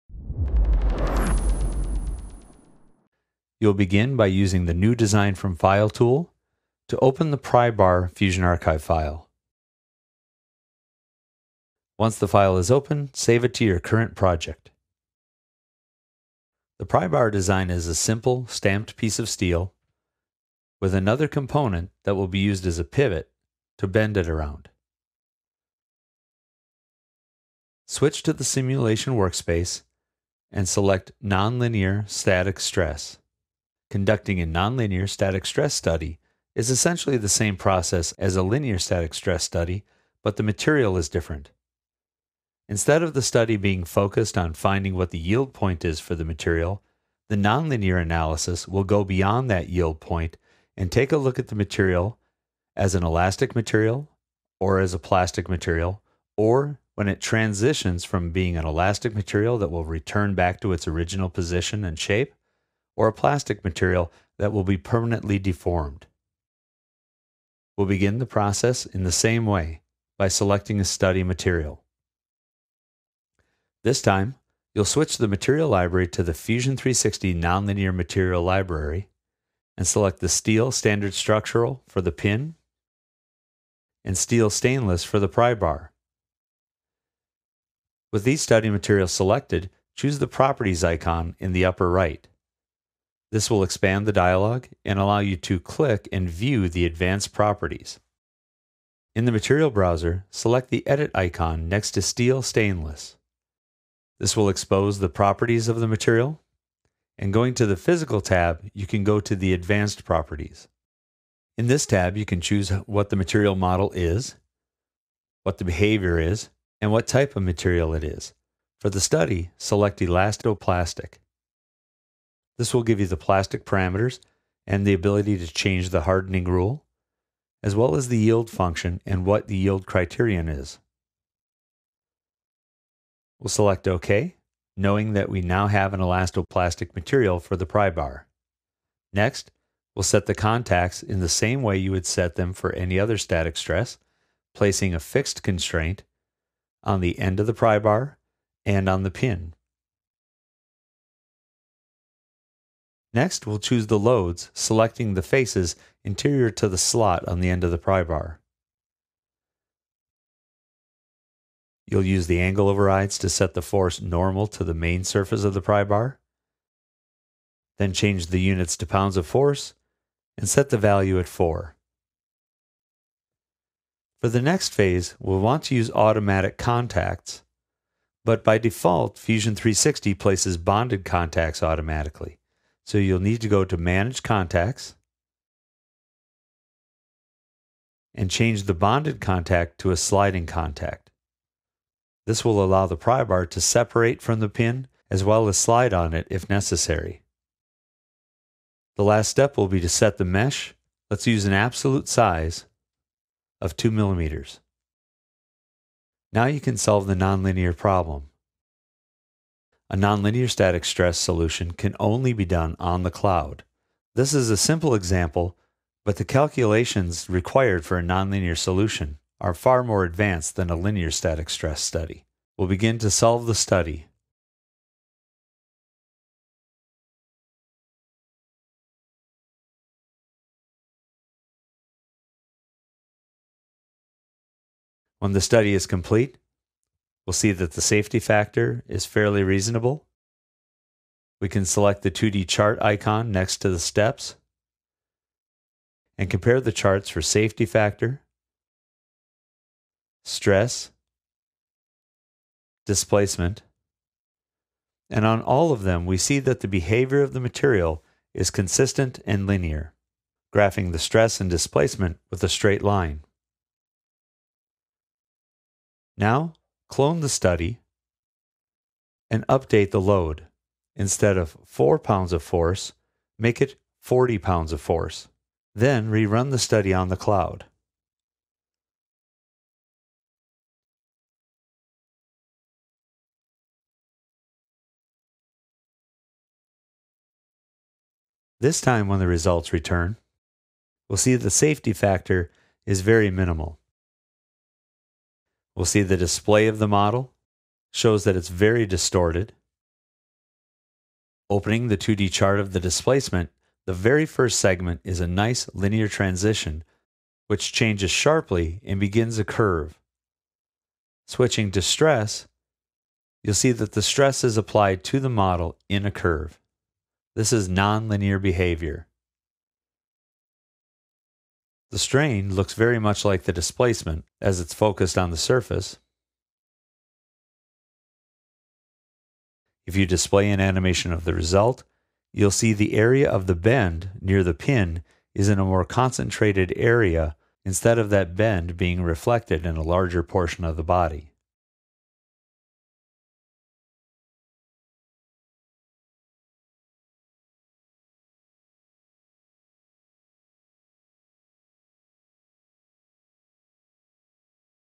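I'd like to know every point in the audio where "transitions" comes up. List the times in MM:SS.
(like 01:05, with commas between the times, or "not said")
00:57, 05:06.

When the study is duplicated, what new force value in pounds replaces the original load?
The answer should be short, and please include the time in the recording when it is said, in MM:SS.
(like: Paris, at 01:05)
40, at 04:34.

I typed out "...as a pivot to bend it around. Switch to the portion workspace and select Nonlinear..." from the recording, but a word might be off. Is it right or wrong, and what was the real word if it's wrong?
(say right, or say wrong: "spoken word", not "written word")
wrong: "simulation", not "portion".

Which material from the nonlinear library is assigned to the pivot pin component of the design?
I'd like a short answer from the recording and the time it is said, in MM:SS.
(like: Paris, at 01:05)
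Steel standard structural, at 01:20.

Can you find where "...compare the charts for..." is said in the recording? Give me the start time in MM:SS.
04:06.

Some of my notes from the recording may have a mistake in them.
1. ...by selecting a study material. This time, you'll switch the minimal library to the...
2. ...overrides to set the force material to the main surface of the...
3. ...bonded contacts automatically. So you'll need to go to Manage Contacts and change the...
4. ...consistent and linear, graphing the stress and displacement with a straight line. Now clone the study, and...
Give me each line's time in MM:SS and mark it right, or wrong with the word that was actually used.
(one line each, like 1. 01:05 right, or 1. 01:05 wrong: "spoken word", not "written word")
1. 01:10 wrong: "material", not "minimal"
2. 02:42 wrong: "normal", not "material"
3. 03:00 right
4. 04:18 right.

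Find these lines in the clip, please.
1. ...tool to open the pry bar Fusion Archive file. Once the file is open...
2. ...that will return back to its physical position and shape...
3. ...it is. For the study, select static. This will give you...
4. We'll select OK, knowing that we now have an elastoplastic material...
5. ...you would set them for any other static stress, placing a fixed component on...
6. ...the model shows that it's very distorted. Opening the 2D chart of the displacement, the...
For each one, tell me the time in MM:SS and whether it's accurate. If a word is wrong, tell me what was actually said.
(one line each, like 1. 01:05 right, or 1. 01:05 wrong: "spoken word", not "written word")
1. 00:05 right
2. 00:59 wrong: "original", not "physical"
3. 01:57 wrong: "elastoplastic", not "static"
4. 02:13 right
5. 02:21 wrong: "constraint", not "component"
6. 04:56 right.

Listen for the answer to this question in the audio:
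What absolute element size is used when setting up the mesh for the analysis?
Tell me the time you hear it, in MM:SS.
03:23.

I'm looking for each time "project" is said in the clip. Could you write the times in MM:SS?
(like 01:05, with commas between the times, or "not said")
00:14.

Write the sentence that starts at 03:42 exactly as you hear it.
We'll begin to solve the study.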